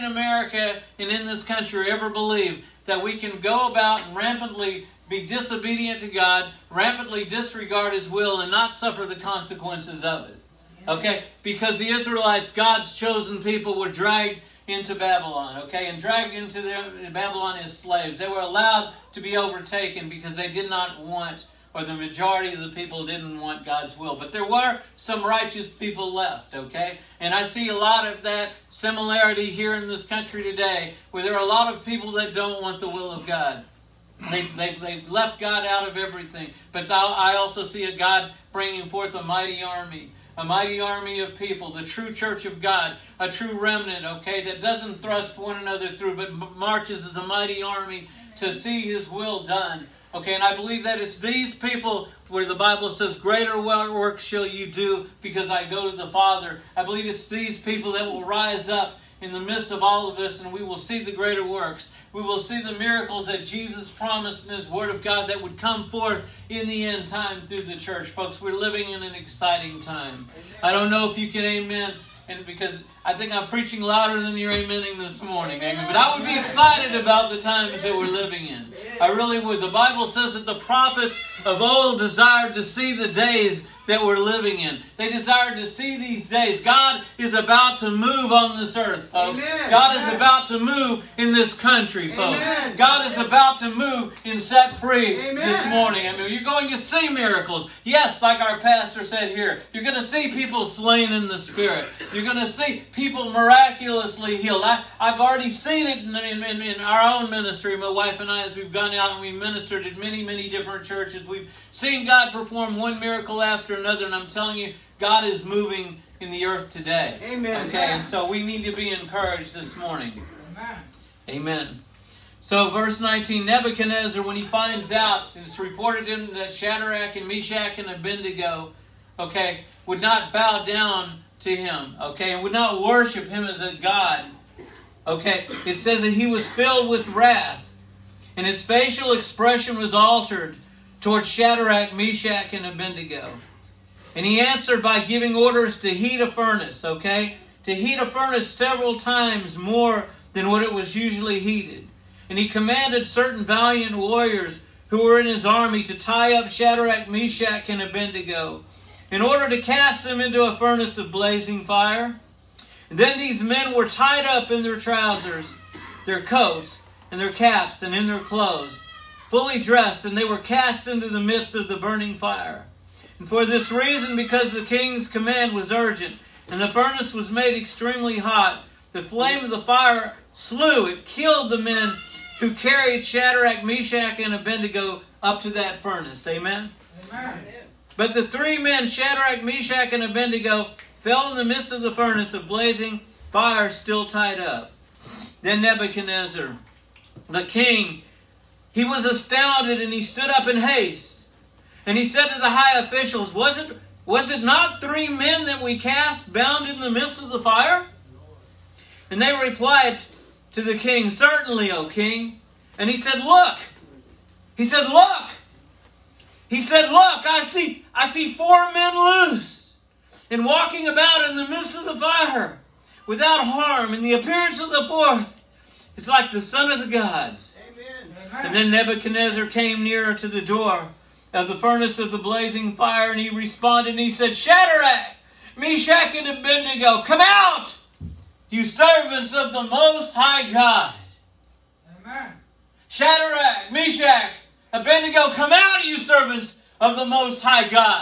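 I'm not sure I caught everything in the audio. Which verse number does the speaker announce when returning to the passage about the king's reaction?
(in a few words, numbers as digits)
19.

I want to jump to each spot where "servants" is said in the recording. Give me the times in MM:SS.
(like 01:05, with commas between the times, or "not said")
03:58, 04:05.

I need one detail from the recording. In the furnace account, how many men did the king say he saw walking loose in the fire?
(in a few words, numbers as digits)
4.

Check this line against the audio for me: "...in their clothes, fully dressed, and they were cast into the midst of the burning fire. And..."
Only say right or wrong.
right.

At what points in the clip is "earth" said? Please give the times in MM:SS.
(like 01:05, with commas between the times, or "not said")
01:28, 01:56.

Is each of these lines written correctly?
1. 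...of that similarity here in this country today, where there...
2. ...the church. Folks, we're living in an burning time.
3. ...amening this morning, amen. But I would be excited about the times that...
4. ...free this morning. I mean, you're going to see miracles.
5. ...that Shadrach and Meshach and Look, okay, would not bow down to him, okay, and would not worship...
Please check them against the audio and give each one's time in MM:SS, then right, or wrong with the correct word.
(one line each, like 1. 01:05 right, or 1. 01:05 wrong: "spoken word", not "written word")
1. 00:28 right
2. 01:07 wrong: "exciting", not "burning"
3. 01:14 right
4. 01:34 right
5. 02:06 wrong: "Abednego", not "Look".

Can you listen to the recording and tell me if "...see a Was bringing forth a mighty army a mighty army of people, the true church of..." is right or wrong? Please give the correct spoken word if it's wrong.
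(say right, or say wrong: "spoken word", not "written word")
wrong: "God", not "Was".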